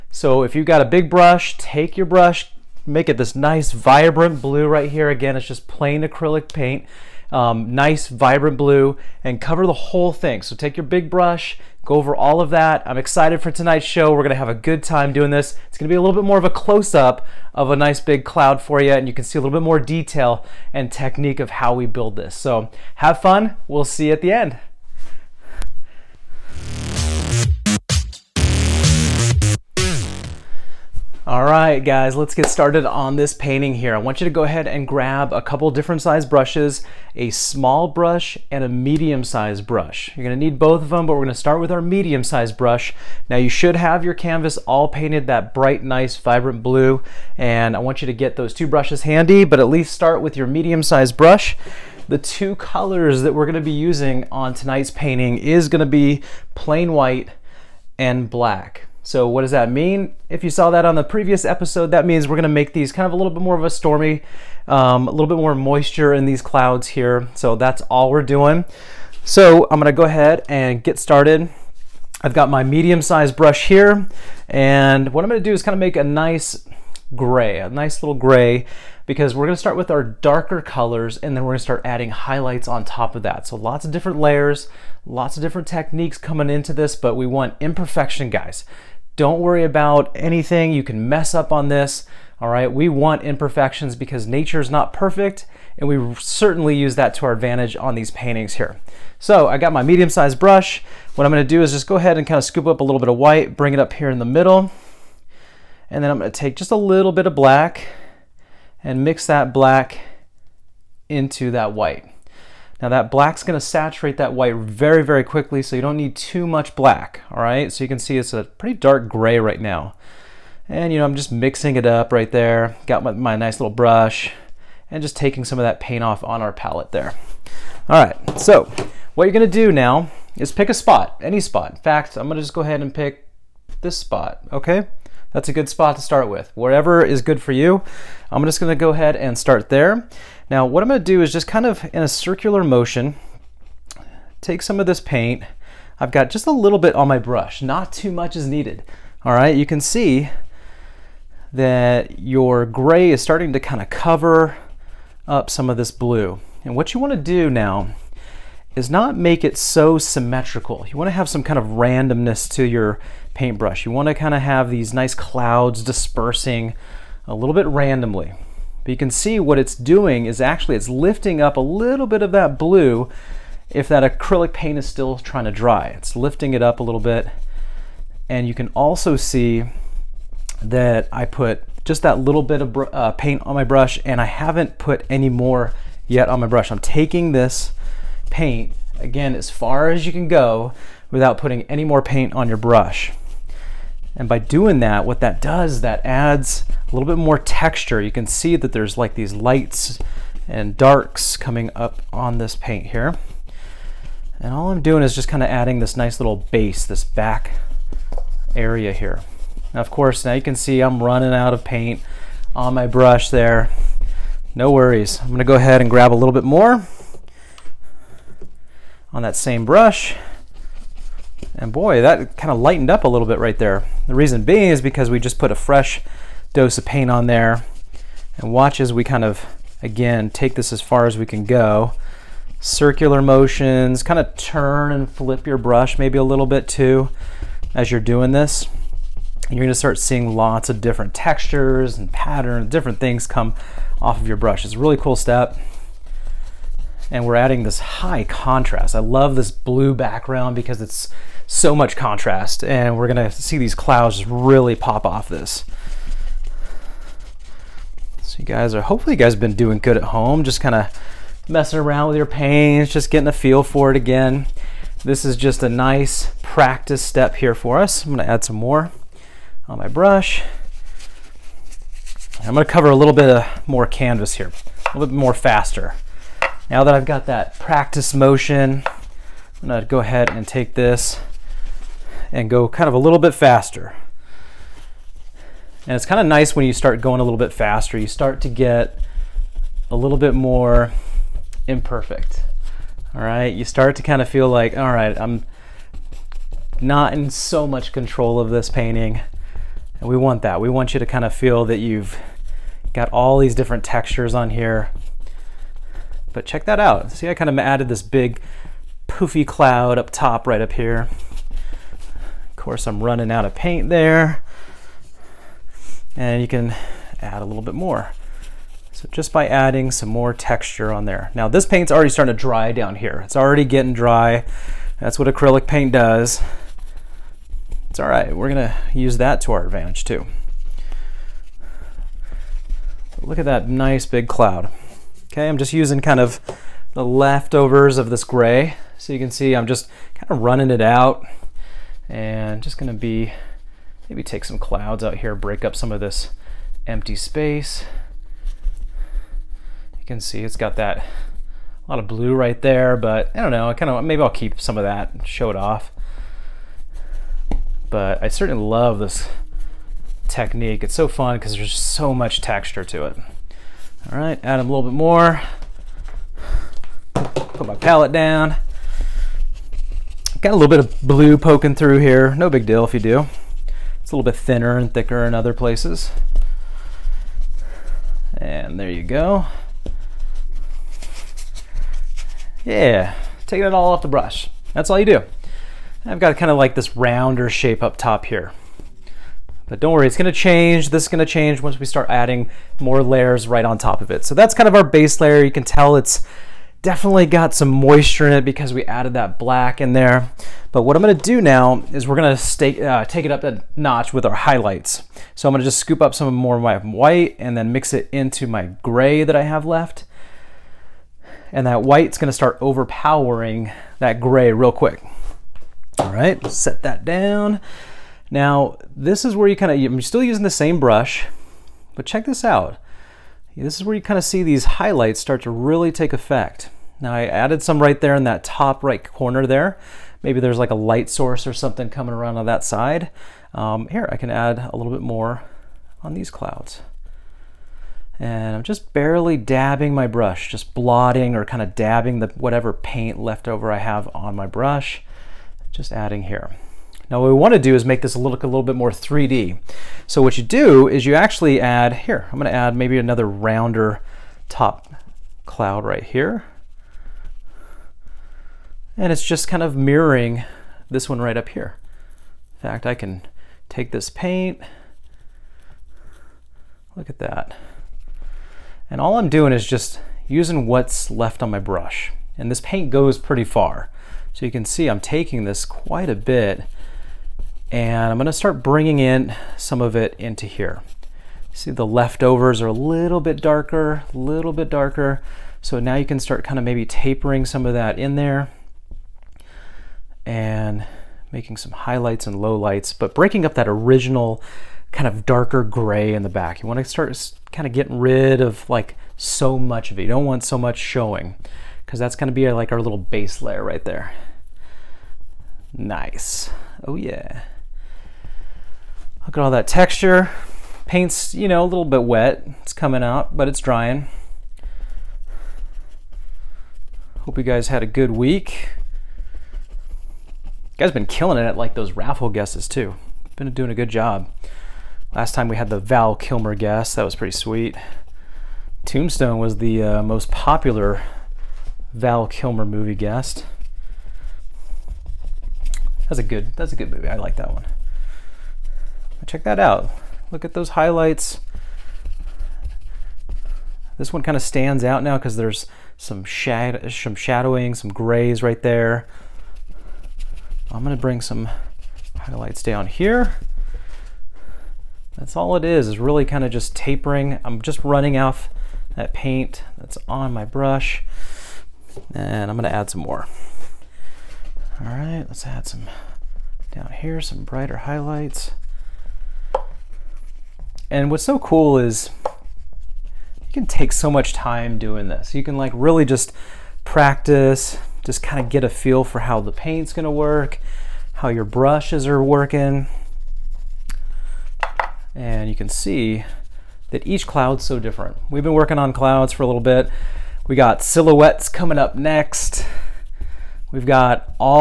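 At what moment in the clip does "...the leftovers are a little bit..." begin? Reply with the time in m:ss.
8:01.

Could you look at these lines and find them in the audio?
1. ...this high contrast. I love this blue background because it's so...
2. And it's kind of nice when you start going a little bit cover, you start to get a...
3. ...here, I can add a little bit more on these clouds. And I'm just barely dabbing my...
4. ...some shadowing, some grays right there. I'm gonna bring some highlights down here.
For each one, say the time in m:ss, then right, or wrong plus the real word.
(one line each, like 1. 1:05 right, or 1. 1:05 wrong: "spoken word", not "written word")
1. 4:07 right
2. 4:45 wrong: "faster", not "cover"
3. 7:13 right
4. 9:06 right.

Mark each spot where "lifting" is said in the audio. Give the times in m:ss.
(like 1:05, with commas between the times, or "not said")
2:50, 2:56.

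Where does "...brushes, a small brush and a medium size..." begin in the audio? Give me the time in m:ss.
0:36.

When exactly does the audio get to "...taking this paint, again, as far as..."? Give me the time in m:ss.
3:06.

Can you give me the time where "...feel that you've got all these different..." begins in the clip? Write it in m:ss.
5:01.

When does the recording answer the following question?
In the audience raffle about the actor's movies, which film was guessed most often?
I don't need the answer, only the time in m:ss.
8:48.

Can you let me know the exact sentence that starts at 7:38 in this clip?
And it's just kind of mirroring this one right up here.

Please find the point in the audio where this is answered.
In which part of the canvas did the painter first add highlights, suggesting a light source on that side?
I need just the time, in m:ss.
7:08.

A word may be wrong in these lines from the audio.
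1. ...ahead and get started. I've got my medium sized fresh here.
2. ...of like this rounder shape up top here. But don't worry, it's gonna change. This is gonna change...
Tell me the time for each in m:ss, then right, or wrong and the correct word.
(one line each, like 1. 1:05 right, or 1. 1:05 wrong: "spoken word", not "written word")
1. 1:10 wrong: "brush", not "fresh"
2. 6:26 right.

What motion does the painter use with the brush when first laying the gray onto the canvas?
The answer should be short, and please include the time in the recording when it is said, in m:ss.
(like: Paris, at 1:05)
Circular motion, at 2:22.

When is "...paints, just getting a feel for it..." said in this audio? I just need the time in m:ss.
4:22.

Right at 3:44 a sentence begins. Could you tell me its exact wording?
The reason being is because we just put a fresh dose of paint on there.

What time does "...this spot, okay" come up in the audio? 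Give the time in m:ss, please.
2:13.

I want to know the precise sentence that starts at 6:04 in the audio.
All right, add a little bit more.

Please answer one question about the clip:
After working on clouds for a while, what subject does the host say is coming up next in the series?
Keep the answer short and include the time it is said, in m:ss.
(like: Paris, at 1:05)
Silhouettes, at 9:50.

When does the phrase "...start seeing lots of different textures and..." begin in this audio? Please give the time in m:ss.
3:59.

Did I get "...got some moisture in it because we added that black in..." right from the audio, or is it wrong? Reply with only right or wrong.
right.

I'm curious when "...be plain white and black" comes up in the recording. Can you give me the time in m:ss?
0:55.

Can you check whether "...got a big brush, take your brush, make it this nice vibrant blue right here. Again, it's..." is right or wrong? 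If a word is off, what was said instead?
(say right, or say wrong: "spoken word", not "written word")
right.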